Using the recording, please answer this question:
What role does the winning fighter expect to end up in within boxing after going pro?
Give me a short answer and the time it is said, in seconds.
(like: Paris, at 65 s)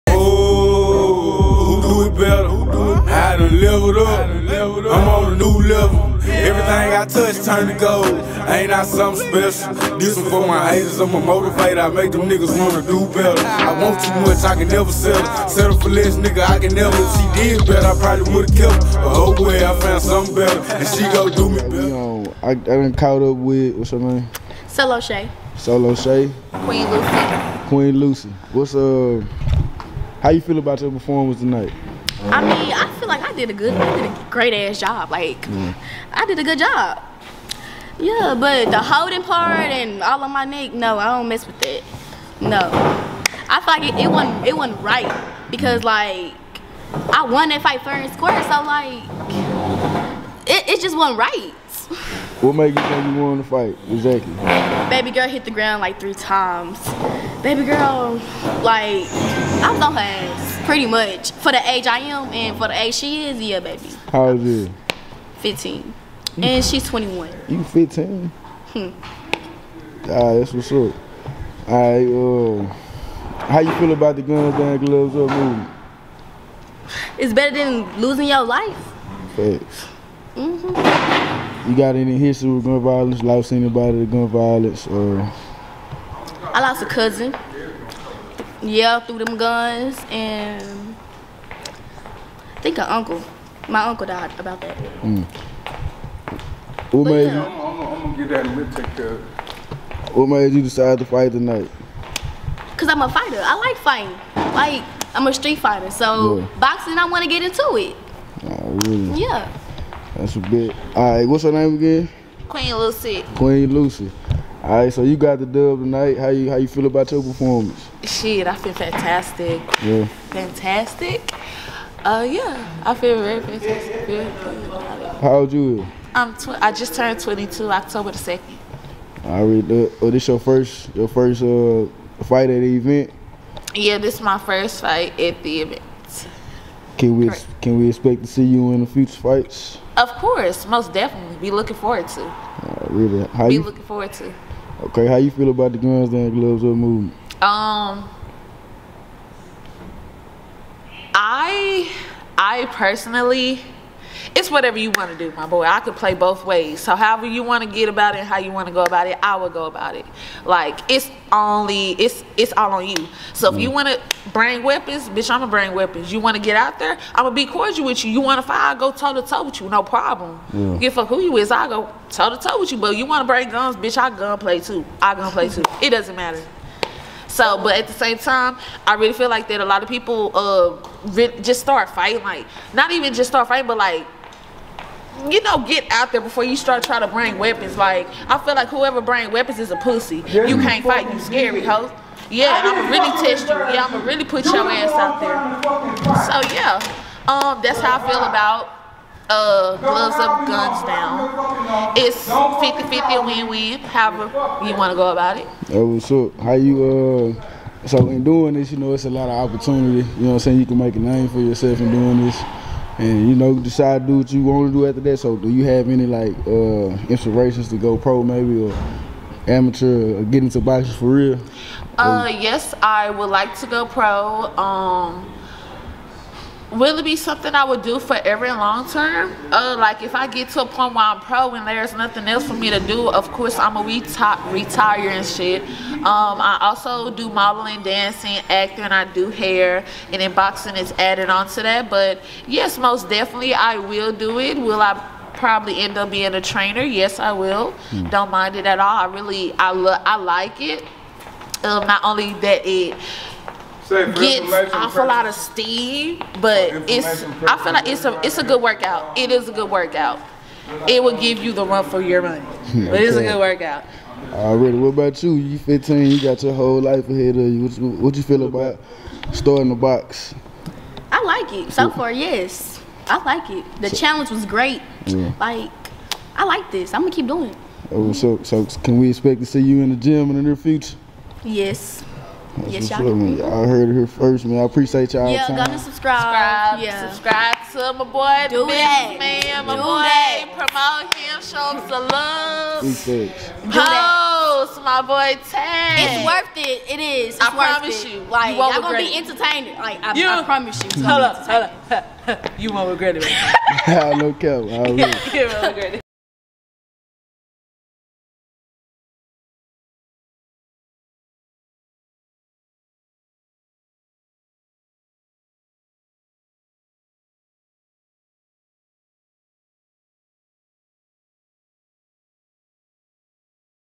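trainer, at 246 s.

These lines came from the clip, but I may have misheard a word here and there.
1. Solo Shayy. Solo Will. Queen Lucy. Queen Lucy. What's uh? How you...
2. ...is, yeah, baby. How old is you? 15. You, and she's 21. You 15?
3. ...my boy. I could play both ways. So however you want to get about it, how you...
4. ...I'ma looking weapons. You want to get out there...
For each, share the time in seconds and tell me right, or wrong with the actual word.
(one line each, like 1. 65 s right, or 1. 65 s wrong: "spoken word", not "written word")
1. 24 s wrong: "Shayy", not "Will"
2. 63 s right
3. 155 s right
4. 165 s wrong: "bring", not "looking".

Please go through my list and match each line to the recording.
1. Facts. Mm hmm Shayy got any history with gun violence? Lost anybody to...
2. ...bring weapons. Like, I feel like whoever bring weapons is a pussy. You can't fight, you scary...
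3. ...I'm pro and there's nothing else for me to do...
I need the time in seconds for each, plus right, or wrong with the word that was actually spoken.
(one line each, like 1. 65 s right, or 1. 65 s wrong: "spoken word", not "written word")
1. 79 s wrong: "You", not "Shayy"
2. 187 s right
3. 231 s right.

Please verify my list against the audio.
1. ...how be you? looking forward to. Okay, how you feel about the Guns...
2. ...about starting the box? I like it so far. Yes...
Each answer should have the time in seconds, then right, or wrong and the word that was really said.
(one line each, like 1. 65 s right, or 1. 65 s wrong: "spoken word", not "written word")
1. 143 s right
2. 268 s right.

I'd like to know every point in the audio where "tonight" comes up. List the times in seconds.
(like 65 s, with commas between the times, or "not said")
31 s, 101 s, 115 s.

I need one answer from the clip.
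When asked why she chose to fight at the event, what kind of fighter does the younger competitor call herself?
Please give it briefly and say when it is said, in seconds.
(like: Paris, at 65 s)
street fighter, at 105 s.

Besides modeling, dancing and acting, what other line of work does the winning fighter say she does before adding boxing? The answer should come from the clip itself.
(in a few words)
hair.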